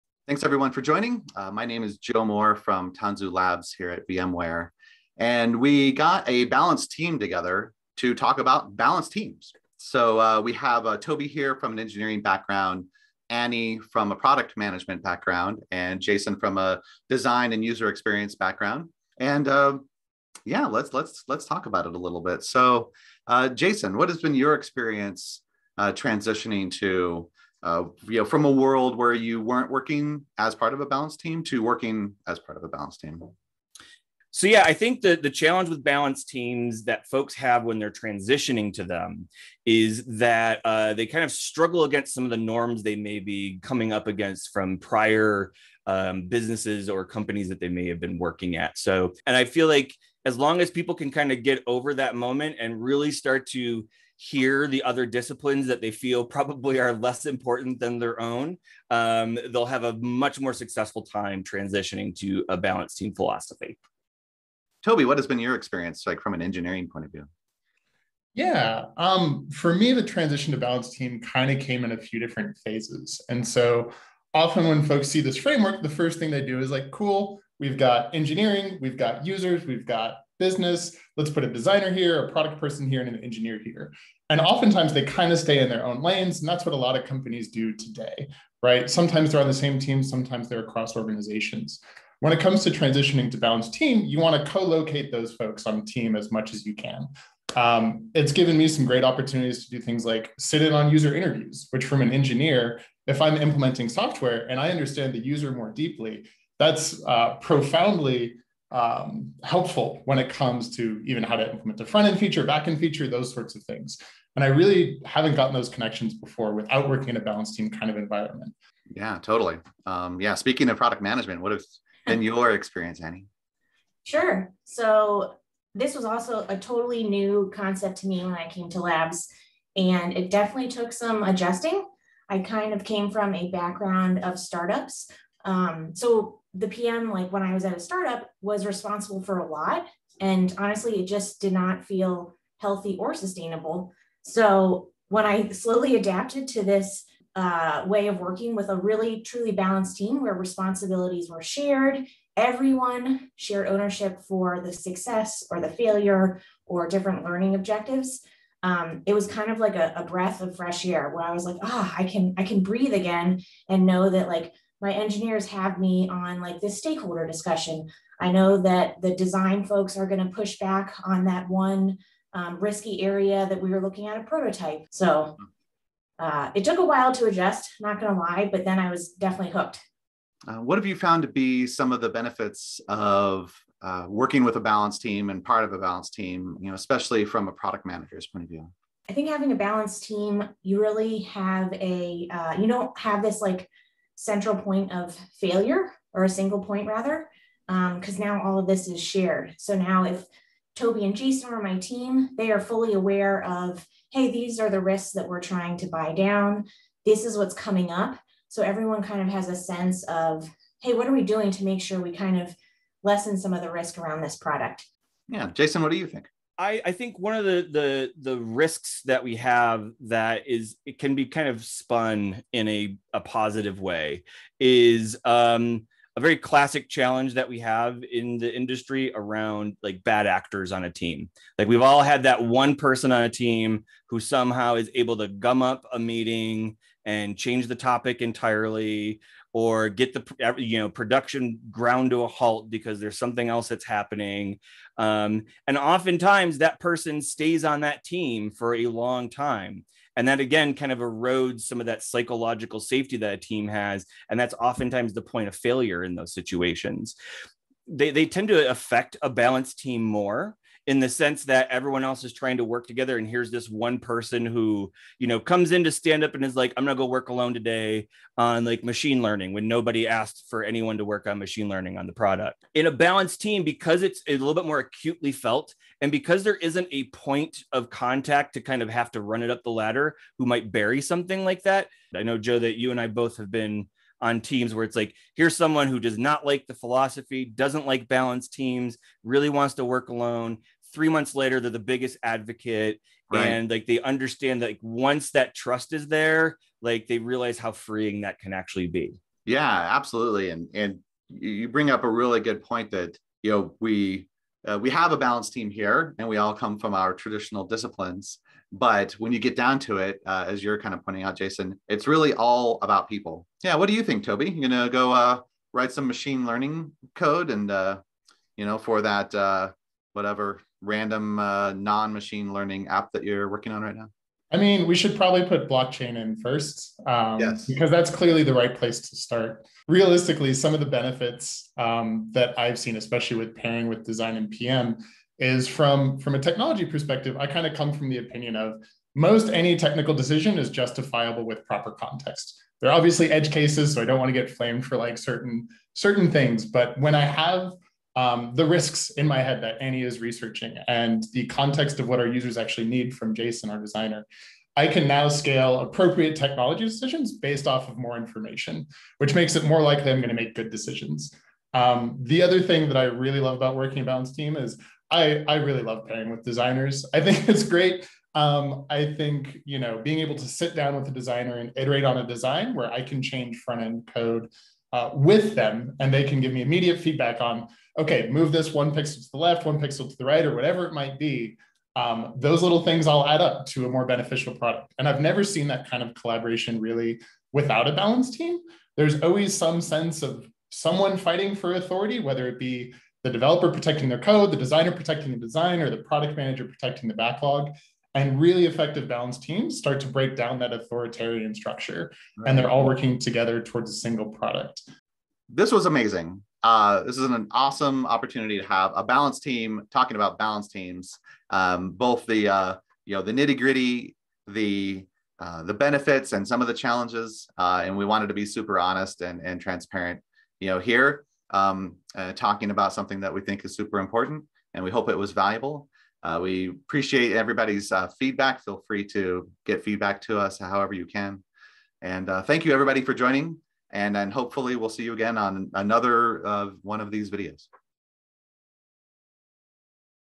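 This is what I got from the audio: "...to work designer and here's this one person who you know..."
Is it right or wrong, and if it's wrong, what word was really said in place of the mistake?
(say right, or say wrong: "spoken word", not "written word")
wrong: "together", not "designer".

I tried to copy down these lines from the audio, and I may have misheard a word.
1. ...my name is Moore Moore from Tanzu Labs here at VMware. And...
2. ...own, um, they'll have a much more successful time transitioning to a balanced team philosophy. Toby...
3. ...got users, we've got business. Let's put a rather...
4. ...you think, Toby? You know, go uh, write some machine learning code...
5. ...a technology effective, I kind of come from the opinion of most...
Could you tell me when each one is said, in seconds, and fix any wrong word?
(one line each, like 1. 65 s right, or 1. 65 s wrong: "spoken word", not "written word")
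1. 1 s wrong: "Joe", not "Moore"
2. 58 s right
3. 78 s wrong: "designer", not "rather"
4. 313 s right
5. 336 s wrong: "perspective", not "effective".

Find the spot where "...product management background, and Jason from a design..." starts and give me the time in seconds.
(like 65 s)
14 s.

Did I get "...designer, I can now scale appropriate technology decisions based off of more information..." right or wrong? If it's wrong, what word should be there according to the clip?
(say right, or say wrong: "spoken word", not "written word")
right.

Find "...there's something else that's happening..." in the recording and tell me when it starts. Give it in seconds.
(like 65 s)
242 s.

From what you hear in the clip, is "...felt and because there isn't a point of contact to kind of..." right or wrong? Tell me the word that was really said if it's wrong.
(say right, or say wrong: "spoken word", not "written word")
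right.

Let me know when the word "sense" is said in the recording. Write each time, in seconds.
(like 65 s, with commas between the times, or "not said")
209 s, 261 s, 389 s.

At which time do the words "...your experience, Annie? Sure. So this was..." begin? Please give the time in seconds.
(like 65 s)
122 s.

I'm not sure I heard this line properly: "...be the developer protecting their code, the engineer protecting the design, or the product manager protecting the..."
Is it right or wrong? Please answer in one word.
wrong.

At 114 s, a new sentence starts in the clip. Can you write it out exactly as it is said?
And I really haven't gotten those connections before without working in a balanced team kind of environment.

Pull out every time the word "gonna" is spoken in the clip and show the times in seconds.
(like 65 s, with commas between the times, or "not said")
266 s.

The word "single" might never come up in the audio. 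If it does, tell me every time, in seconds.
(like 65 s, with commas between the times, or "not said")
196 s, 403 s.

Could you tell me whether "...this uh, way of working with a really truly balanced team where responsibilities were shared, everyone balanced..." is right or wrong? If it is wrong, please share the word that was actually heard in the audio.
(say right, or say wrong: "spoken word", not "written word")
wrong: "shared", not "balanced".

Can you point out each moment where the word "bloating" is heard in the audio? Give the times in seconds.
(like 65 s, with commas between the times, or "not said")
not said.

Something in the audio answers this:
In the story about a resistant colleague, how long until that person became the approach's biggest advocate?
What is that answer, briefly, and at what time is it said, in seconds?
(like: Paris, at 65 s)
3 months, at 290 s.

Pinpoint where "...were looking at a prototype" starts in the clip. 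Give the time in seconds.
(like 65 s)
173 s.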